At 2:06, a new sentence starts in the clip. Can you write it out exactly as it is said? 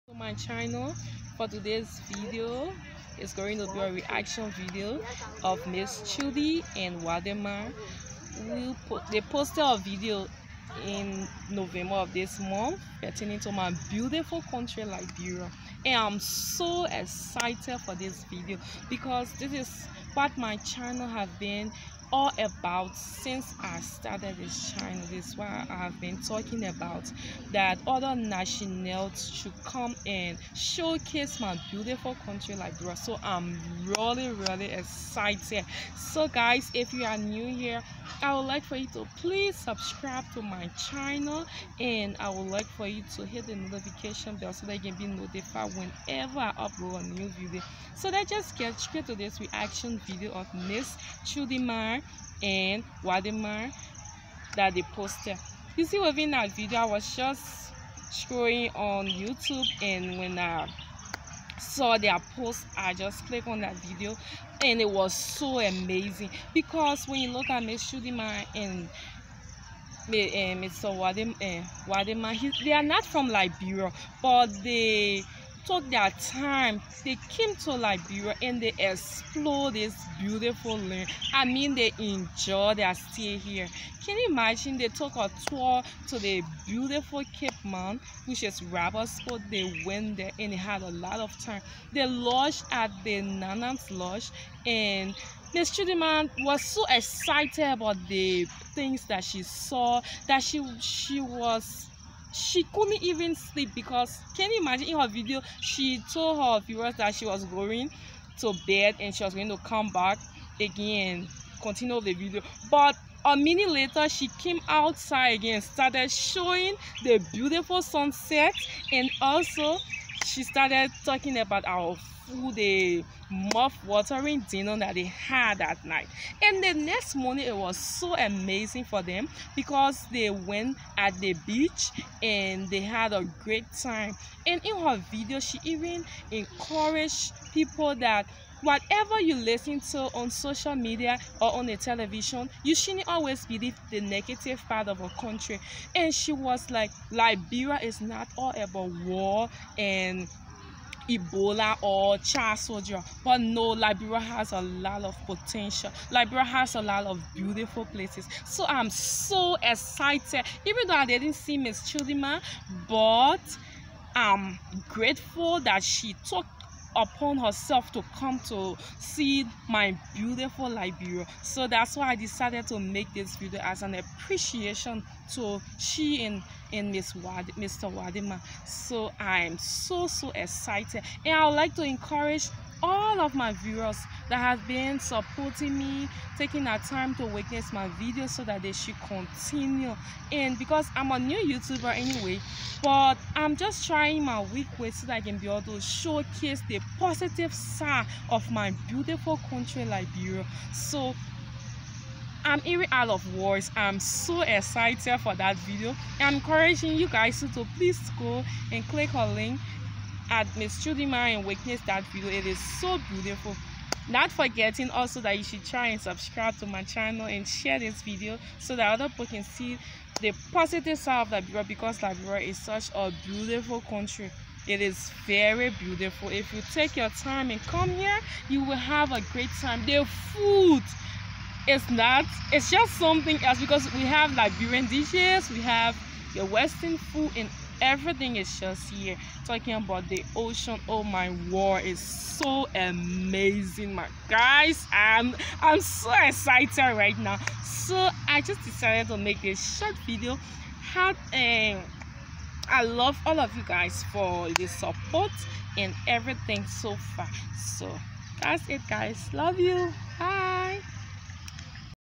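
And the next morning, it was so amazing for them because they went at the beach and they had a great time.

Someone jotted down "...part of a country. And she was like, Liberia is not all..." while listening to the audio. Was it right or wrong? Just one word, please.
right.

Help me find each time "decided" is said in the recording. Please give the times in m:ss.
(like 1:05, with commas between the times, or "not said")
2:52, 4:08.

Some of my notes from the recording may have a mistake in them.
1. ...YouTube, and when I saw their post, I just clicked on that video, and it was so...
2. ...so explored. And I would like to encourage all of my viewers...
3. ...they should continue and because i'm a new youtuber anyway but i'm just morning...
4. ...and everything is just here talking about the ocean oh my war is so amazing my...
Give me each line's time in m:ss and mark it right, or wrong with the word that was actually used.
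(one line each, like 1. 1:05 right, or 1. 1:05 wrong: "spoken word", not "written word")
1. 0:59 right
2. 3:00 wrong: "excited", not "explored"
3. 3:08 wrong: "trying", not "morning"
4. 3:57 right.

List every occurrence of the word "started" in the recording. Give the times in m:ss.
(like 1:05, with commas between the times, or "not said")
0:23, 1:55, 2:00.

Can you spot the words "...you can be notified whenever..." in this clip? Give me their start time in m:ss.
0:44.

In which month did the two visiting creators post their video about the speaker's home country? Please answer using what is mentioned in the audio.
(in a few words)
November.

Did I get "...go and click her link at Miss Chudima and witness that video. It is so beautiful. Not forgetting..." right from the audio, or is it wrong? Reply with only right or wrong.
right.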